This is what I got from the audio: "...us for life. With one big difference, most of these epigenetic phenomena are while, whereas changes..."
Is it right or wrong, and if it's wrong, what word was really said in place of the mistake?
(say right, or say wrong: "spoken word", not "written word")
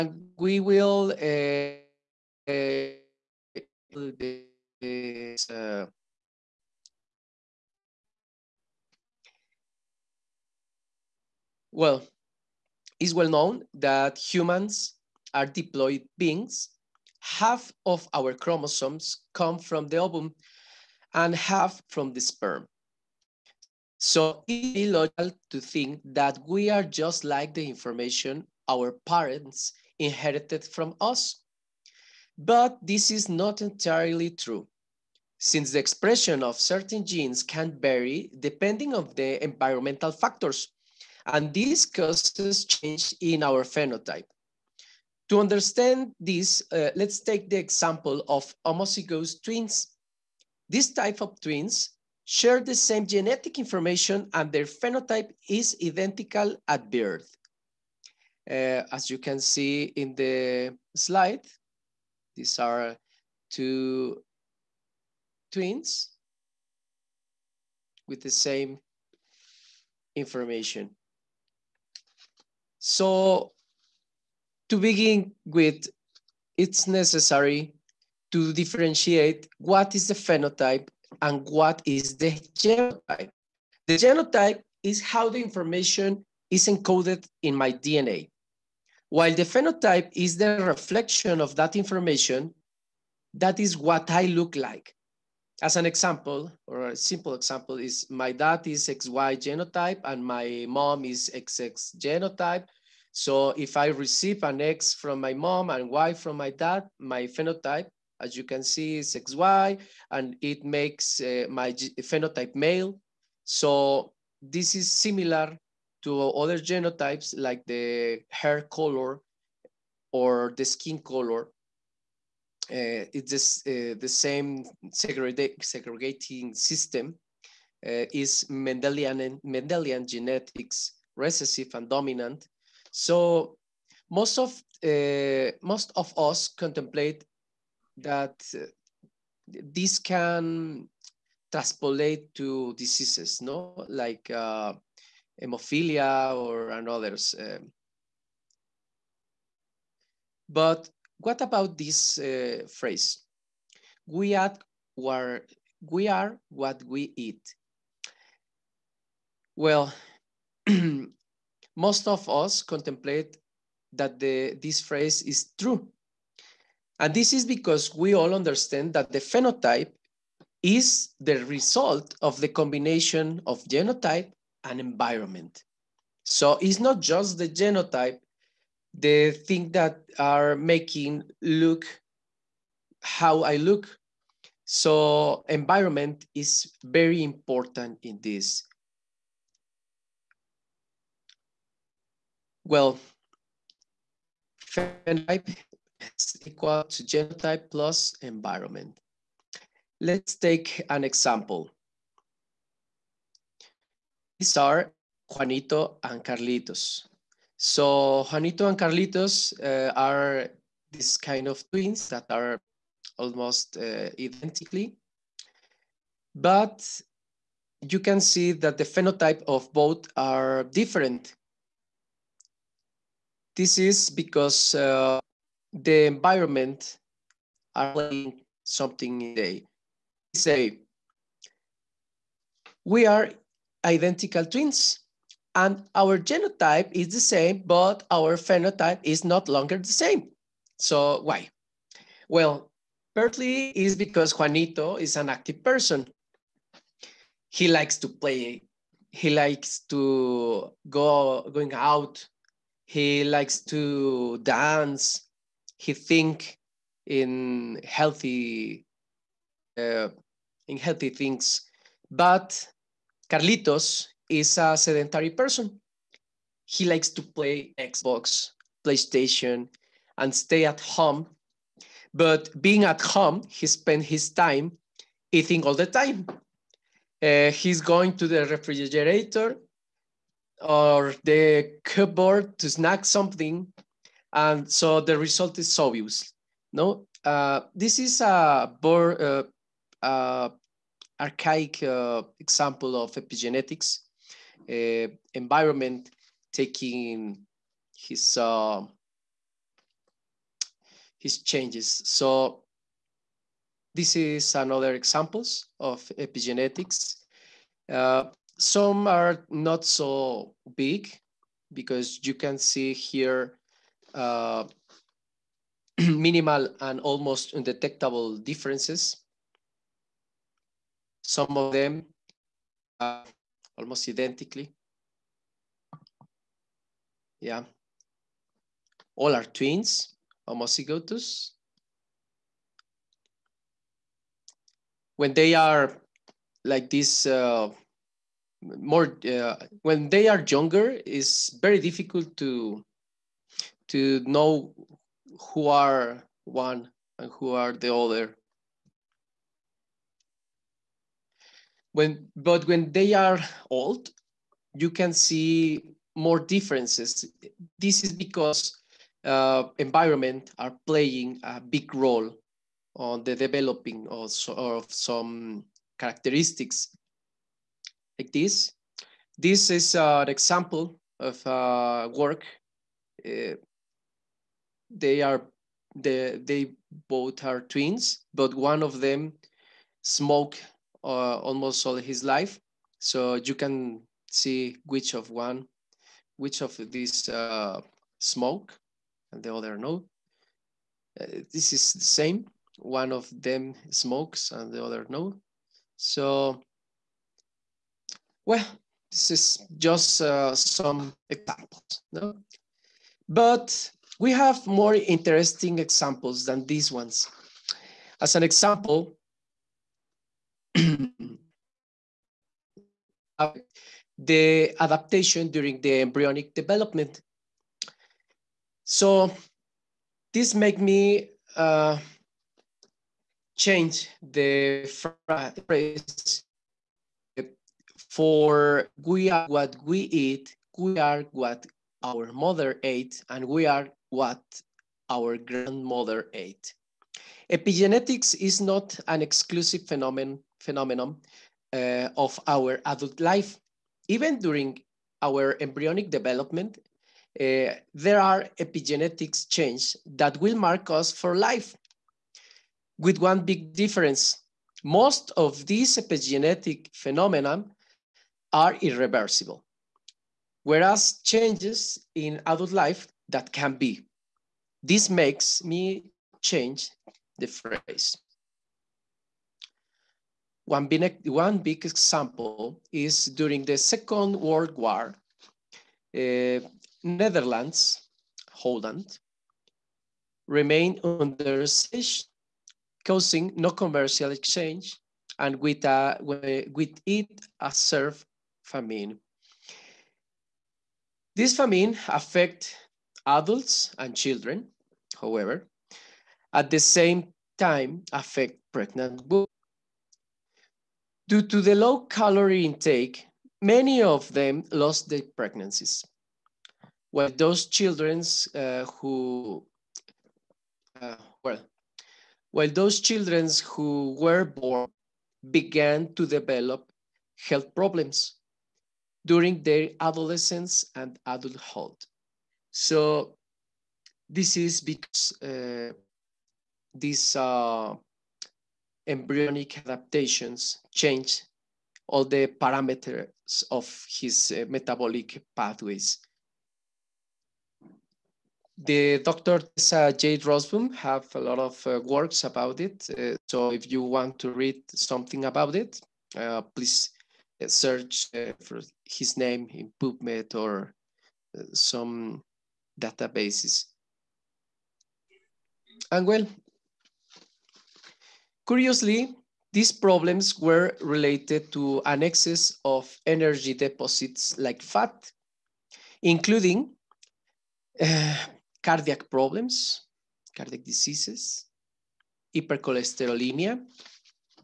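wrong: "irreversible", not "while".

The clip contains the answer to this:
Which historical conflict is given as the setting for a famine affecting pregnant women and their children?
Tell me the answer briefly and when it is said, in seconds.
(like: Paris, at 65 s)
Second World War, at 473 s.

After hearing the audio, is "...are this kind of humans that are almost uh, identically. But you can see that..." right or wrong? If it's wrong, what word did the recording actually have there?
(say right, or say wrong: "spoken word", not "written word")
wrong: "twins", not "humans".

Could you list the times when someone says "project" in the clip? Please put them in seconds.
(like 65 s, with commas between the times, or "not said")
not said.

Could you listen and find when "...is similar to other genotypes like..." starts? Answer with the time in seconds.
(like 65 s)
114 s.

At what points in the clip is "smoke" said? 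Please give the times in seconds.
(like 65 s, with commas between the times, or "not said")
380 s, 388 s, 393 s.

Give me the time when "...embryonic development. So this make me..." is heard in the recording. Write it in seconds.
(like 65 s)
416 s.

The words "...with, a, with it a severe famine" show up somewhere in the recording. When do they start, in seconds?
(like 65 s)
485 s.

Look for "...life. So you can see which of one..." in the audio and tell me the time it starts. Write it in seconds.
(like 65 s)
382 s.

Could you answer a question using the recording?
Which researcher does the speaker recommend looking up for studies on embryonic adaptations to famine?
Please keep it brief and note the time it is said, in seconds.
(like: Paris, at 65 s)
Tessa J. Roseboom, at 539 s.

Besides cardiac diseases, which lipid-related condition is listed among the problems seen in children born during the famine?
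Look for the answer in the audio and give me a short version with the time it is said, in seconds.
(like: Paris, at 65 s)
Hypercholesterolemia, at 572 s.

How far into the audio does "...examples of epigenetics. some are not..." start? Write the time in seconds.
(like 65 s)
304 s.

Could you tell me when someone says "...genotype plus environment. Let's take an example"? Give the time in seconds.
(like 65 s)
197 s.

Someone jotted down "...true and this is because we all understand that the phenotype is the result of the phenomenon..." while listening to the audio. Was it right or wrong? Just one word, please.
wrong.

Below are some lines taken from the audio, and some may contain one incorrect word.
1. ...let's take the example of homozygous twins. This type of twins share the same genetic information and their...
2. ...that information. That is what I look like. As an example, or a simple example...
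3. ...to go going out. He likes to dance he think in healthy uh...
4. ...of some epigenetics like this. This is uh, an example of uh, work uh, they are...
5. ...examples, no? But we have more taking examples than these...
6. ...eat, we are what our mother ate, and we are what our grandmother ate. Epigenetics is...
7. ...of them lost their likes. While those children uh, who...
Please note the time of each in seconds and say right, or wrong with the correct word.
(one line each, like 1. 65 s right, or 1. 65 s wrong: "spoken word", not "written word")
1. 46 s right
2. 91 s right
3. 249 s right
4. 364 s wrong: "characteristics", not "epigenetics"
5. 401 s wrong: "interesting", not "taking"
6. 430 s right
7. 504 s wrong: "pregnancies", not "likes".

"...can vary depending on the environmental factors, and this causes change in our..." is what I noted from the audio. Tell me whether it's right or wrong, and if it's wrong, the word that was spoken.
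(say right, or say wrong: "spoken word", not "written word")
right.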